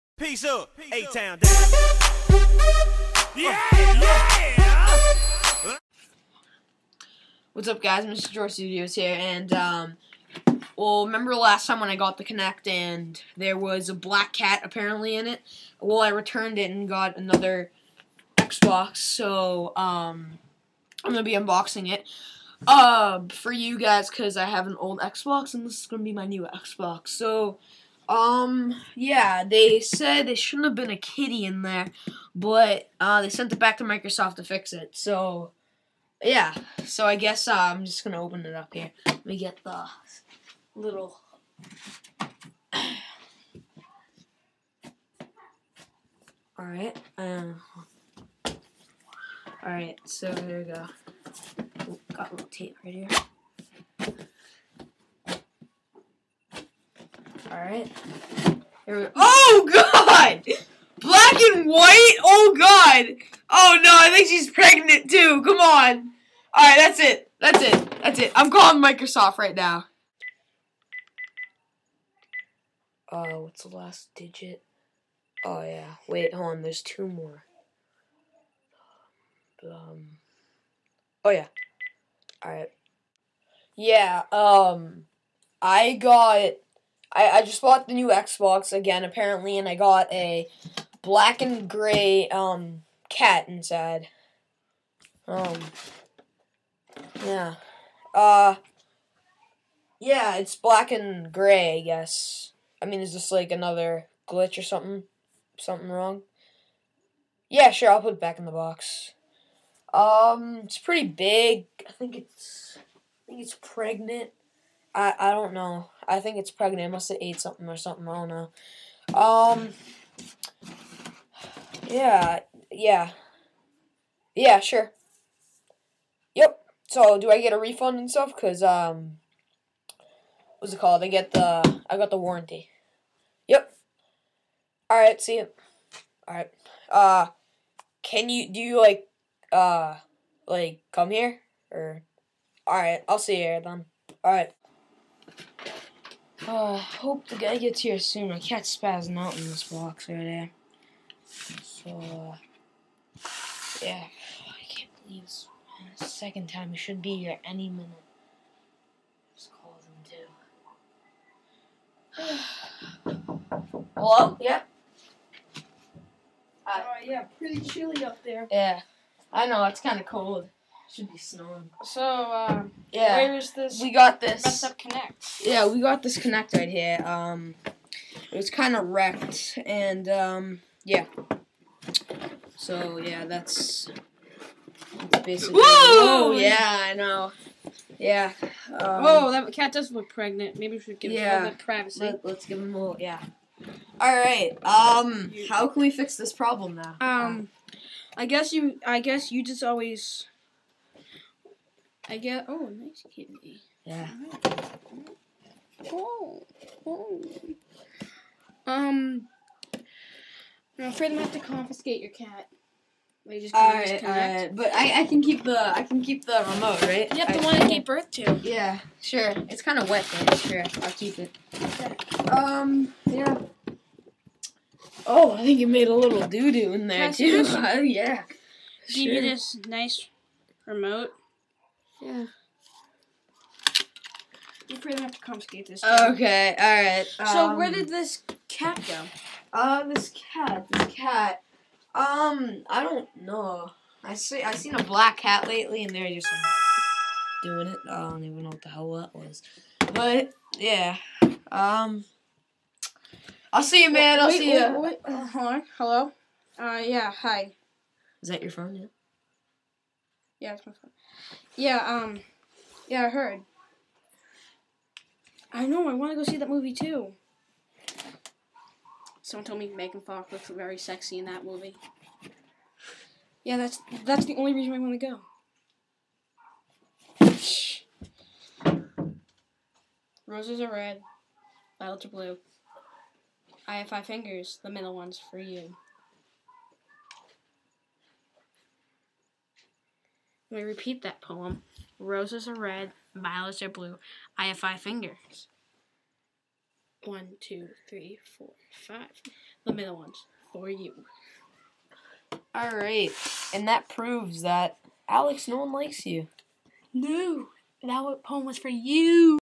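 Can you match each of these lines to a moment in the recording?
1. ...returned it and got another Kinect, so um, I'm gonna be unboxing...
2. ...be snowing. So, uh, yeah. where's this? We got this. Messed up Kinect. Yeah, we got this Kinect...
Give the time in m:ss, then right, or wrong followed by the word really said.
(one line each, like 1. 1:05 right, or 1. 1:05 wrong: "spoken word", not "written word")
1. 0:16 wrong: "Xbox", not "Kinect"
2. 2:51 right.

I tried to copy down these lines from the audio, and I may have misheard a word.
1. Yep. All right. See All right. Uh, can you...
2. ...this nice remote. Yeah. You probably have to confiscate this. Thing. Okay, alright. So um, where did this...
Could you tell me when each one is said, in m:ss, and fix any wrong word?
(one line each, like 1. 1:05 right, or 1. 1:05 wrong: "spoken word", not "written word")
1. 2:13 right
2. 3:49 right.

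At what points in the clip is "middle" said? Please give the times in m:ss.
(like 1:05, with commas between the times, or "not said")
4:44, 4:59.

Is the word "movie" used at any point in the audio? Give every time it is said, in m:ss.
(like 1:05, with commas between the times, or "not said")
4:26, 4:31.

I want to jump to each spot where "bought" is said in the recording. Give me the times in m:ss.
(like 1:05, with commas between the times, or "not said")
1:27.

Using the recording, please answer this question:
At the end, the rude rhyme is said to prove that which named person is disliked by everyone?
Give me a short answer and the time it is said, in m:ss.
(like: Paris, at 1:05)
Alex, at 5:05.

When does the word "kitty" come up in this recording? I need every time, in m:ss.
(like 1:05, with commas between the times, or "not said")
0:30, 3:23.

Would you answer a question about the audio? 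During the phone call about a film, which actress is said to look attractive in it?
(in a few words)
Megan Fox.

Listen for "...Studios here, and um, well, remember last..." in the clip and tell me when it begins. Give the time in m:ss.
0:08.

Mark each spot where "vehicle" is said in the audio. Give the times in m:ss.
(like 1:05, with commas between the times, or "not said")
not said.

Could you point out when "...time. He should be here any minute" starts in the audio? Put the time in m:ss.
2:36.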